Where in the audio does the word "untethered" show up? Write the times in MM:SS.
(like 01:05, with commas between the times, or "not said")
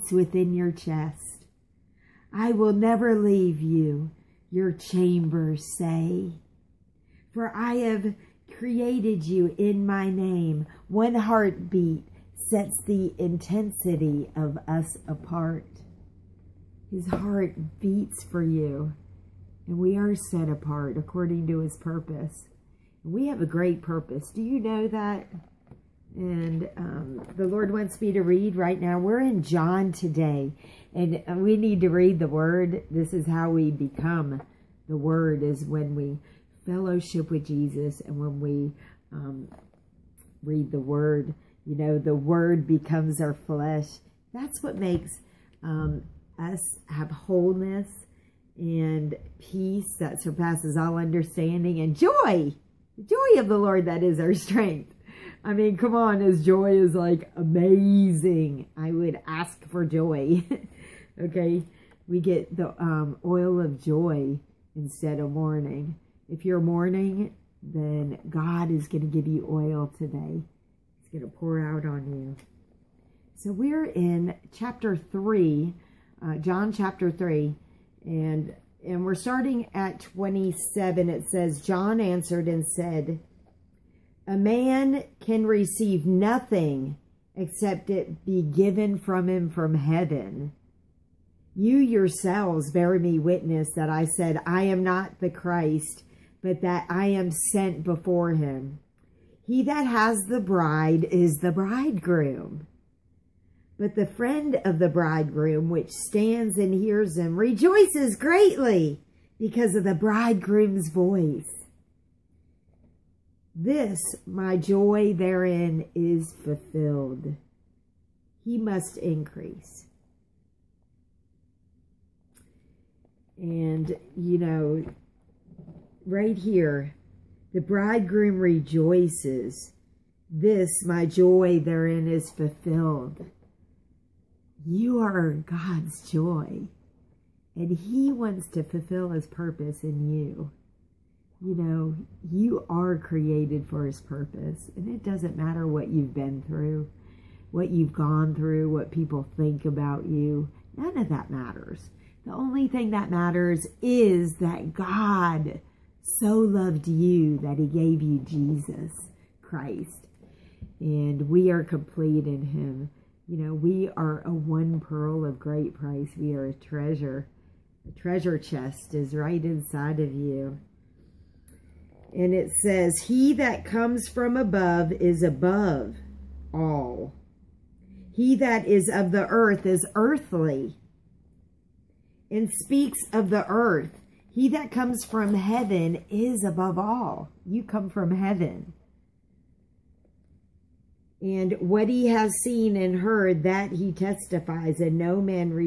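not said.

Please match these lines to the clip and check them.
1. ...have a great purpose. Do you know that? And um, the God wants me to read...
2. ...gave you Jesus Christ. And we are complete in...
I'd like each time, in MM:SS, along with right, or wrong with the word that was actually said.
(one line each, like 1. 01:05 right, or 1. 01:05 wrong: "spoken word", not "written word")
1. 00:23 wrong: "Lord", not "God"
2. 02:37 right.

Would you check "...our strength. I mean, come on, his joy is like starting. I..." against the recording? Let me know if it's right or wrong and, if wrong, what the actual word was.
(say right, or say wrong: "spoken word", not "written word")
wrong: "amazing", not "starting".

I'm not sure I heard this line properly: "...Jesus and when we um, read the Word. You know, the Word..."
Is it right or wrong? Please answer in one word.
right.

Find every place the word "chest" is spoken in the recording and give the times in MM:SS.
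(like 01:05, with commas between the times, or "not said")
00:00, 02:48.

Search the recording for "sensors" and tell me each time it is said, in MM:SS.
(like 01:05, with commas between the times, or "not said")
not said.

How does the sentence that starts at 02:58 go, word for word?
He that is of the earth is earthly and speaks of the earth.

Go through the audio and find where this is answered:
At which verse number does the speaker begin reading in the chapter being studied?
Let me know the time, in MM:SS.
01:19.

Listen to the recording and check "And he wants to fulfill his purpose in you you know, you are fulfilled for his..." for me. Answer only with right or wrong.
wrong.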